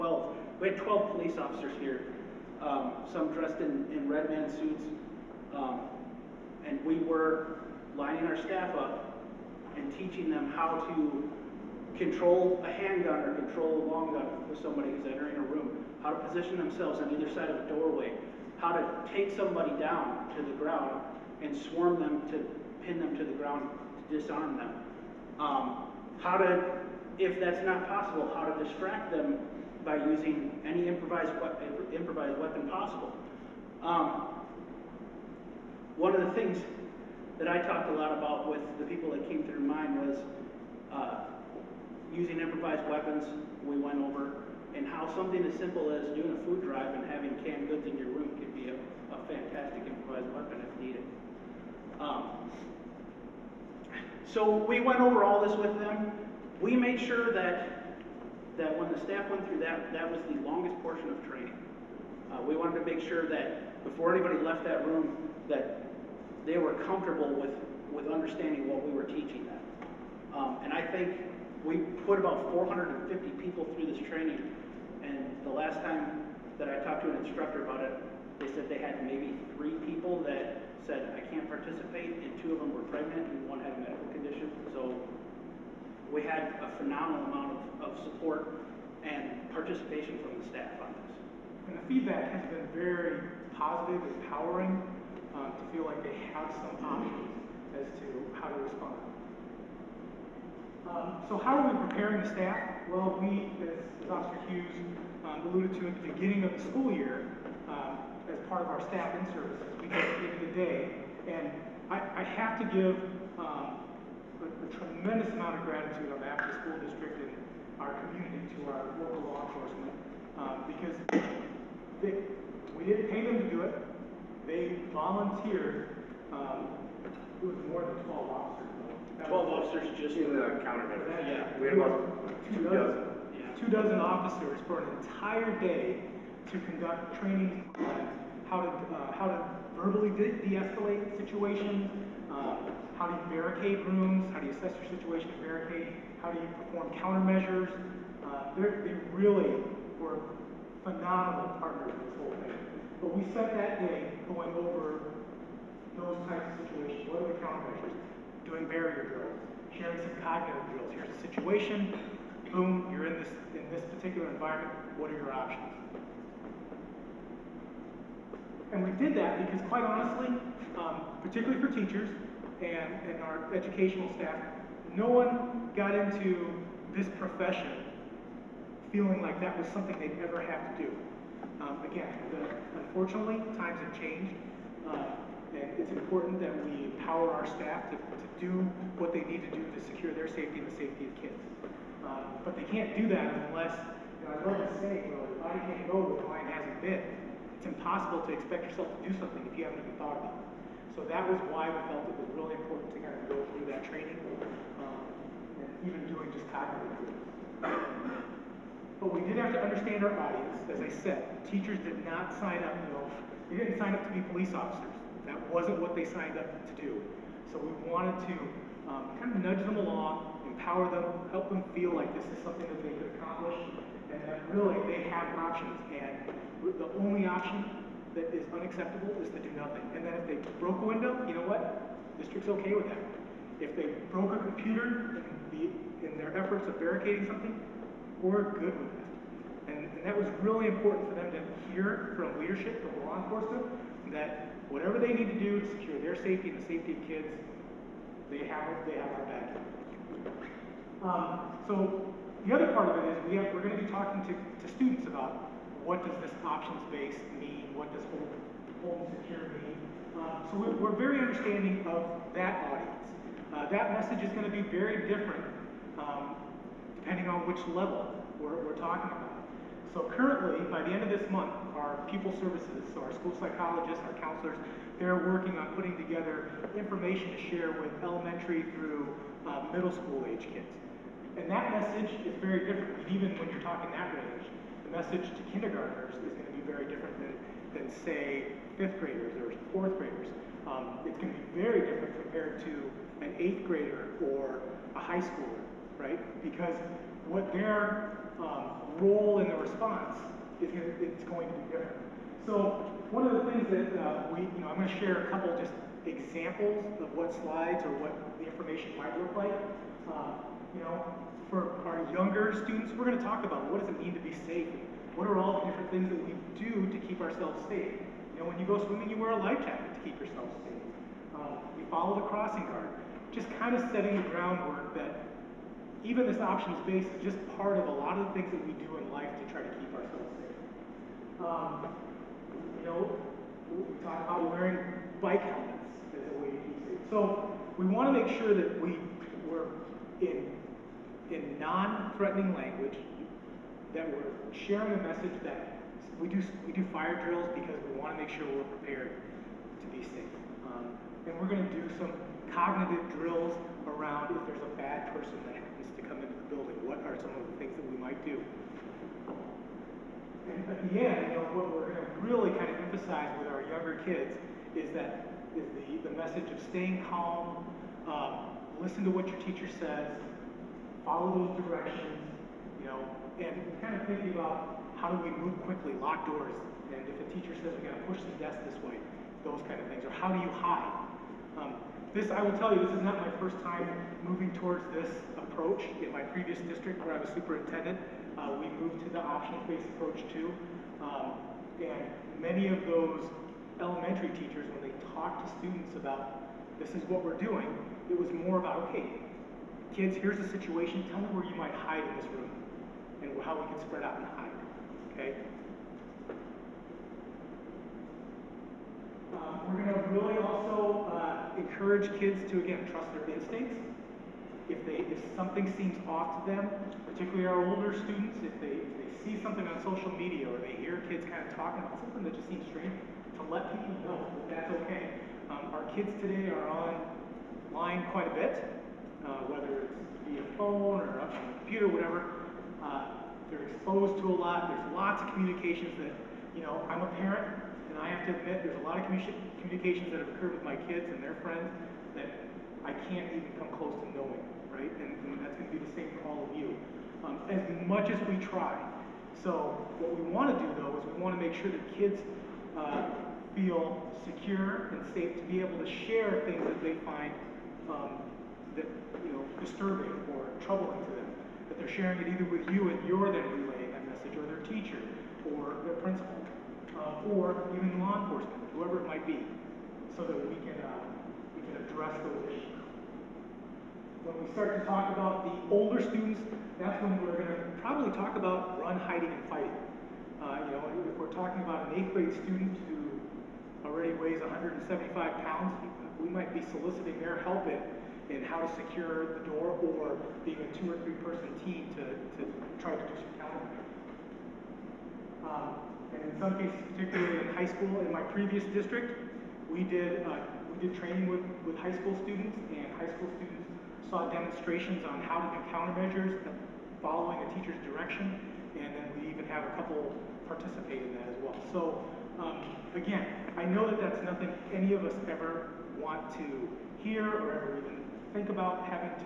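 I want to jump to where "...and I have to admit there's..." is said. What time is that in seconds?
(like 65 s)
437 s.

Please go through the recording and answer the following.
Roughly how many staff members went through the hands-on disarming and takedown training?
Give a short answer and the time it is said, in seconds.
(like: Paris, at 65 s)
450, at 72 s.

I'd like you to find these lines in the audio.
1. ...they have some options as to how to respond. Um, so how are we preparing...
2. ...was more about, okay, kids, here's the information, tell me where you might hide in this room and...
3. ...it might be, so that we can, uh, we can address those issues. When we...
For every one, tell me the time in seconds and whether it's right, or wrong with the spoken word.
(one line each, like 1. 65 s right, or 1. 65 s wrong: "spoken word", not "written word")
1. 96 s right
2. 398 s wrong: "situation", not "information"
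3. 469 s right.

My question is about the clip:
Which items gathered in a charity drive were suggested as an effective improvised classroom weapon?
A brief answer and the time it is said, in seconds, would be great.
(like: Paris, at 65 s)
canned goods, at 47 s.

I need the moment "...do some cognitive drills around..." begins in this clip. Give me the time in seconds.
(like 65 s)
351 s.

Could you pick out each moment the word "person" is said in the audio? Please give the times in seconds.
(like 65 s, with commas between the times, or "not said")
355 s, 491 s.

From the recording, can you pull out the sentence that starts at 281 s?
And that message is very different, even when you're talking that range.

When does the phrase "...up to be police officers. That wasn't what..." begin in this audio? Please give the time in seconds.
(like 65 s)
213 s.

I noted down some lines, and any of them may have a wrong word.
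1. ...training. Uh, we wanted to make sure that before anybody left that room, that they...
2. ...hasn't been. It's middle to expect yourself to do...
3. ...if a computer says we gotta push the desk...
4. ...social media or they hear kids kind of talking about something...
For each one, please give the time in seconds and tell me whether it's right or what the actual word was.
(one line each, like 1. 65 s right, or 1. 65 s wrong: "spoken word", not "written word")
1. 61 s right
2. 196 s wrong: "impossible", not "middle"
3. 377 s wrong: "teacher", not "computer"
4. 419 s right.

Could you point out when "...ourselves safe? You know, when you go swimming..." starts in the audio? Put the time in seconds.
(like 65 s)
317 s.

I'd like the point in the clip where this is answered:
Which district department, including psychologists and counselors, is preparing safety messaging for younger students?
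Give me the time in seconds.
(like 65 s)
272 s.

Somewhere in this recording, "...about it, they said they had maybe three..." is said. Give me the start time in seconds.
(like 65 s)
77 s.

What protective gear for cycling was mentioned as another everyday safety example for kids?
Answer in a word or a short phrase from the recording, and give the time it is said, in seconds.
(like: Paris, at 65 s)
bike helmets, at 335 s.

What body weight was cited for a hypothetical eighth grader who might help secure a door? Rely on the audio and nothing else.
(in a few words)
175 pounds.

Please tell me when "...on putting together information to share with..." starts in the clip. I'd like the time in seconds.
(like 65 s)
275 s.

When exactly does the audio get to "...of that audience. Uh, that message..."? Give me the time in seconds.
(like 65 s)
261 s.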